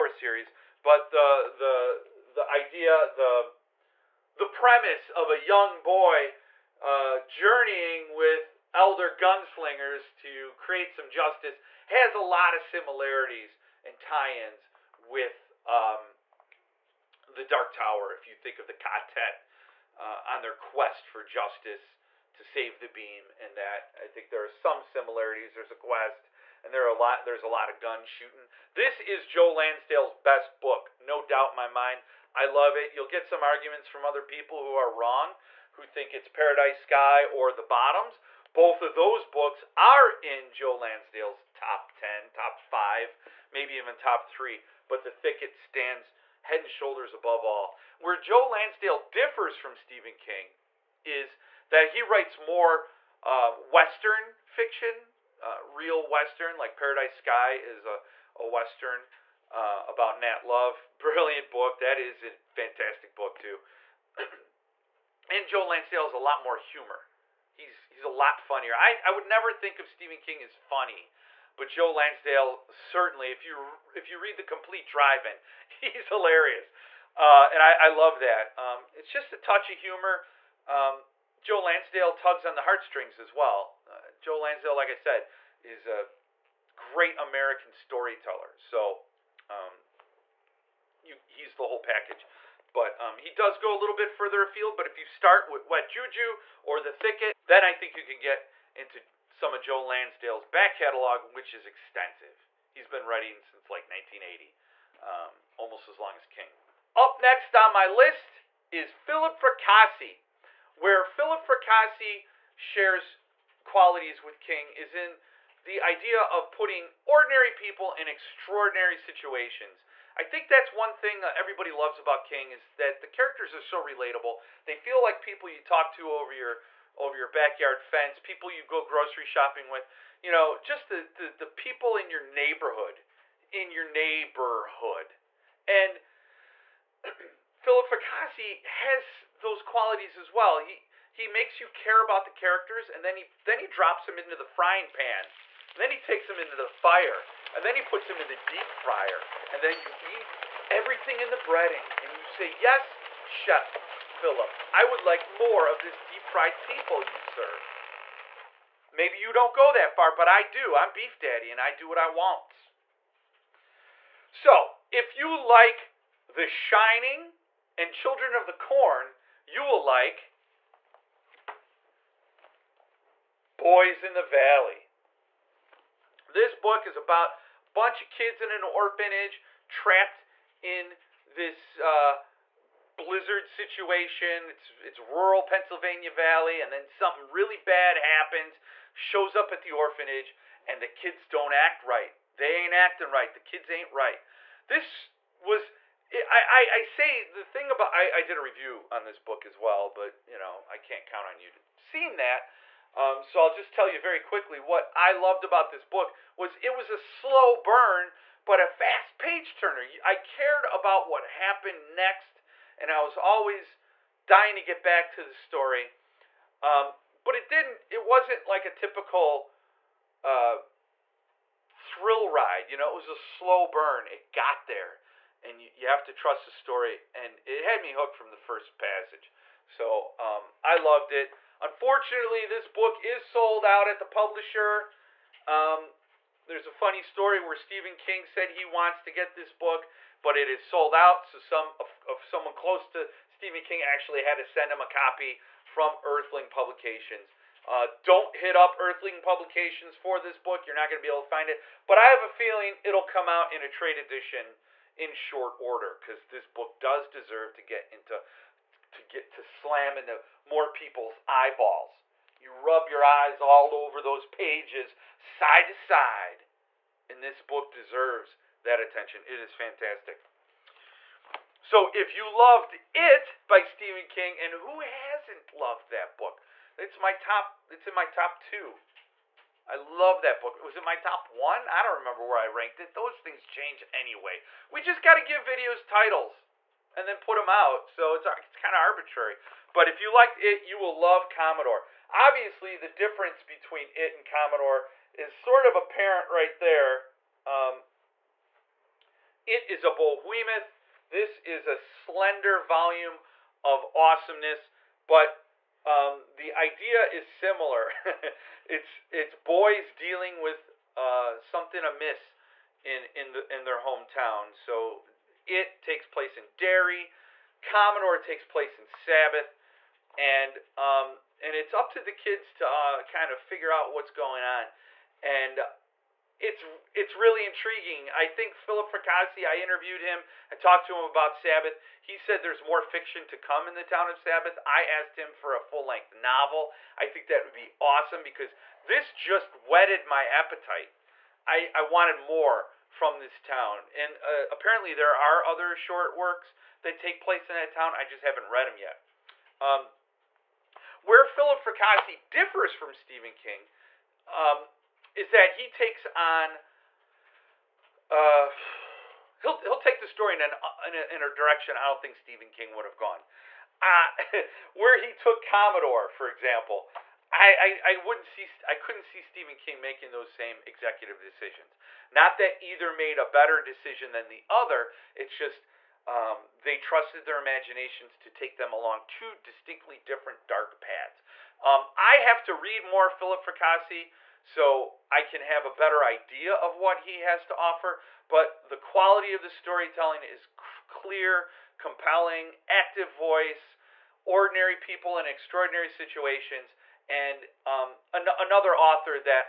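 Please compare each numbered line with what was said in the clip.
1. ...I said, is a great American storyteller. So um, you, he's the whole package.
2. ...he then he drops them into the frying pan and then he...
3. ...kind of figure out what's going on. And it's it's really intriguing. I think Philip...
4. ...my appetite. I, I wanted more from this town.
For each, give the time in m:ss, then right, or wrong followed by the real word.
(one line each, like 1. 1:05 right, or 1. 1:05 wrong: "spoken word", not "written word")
1. 1:24 right
2. 2:23 right
3. 5:23 right
4. 5:40 right.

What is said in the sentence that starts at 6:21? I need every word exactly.
Um, I have to read more Philip Fracassi so I can have a better idea of what he has to offer.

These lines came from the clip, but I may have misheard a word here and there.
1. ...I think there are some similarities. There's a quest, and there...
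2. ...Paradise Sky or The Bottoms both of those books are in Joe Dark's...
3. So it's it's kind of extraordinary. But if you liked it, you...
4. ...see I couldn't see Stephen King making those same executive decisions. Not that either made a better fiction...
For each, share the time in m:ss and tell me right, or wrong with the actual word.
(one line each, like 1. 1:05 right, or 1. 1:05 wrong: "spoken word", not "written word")
1. 0:24 right
2. 0:36 wrong: "Lansdale", not "Dark"
3. 4:47 wrong: "arbitrary", not "extraordinary"
4. 6:08 wrong: "decision", not "fiction".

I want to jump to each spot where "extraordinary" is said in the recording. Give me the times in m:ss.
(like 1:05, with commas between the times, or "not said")
1:58, 6:35.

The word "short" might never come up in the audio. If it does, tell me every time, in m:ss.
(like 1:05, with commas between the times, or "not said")
4:15, 5:45.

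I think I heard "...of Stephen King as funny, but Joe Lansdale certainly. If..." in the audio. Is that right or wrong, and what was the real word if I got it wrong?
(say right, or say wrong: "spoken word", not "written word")
right.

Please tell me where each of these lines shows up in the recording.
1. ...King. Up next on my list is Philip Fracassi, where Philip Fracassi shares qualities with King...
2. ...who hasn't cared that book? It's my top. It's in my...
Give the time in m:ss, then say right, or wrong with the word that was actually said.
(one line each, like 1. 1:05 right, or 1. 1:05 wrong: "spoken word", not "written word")
1. 1:46 right
2. 4:34 wrong: "loved", not "cared".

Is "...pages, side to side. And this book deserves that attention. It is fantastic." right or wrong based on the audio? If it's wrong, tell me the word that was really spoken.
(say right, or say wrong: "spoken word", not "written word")
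right.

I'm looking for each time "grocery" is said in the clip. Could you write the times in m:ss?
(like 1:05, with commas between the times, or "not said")
2:08.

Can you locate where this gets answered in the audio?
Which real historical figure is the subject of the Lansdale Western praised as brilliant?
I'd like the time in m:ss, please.
1:00.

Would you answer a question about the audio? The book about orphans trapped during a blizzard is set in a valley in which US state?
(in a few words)
Pennsylvania.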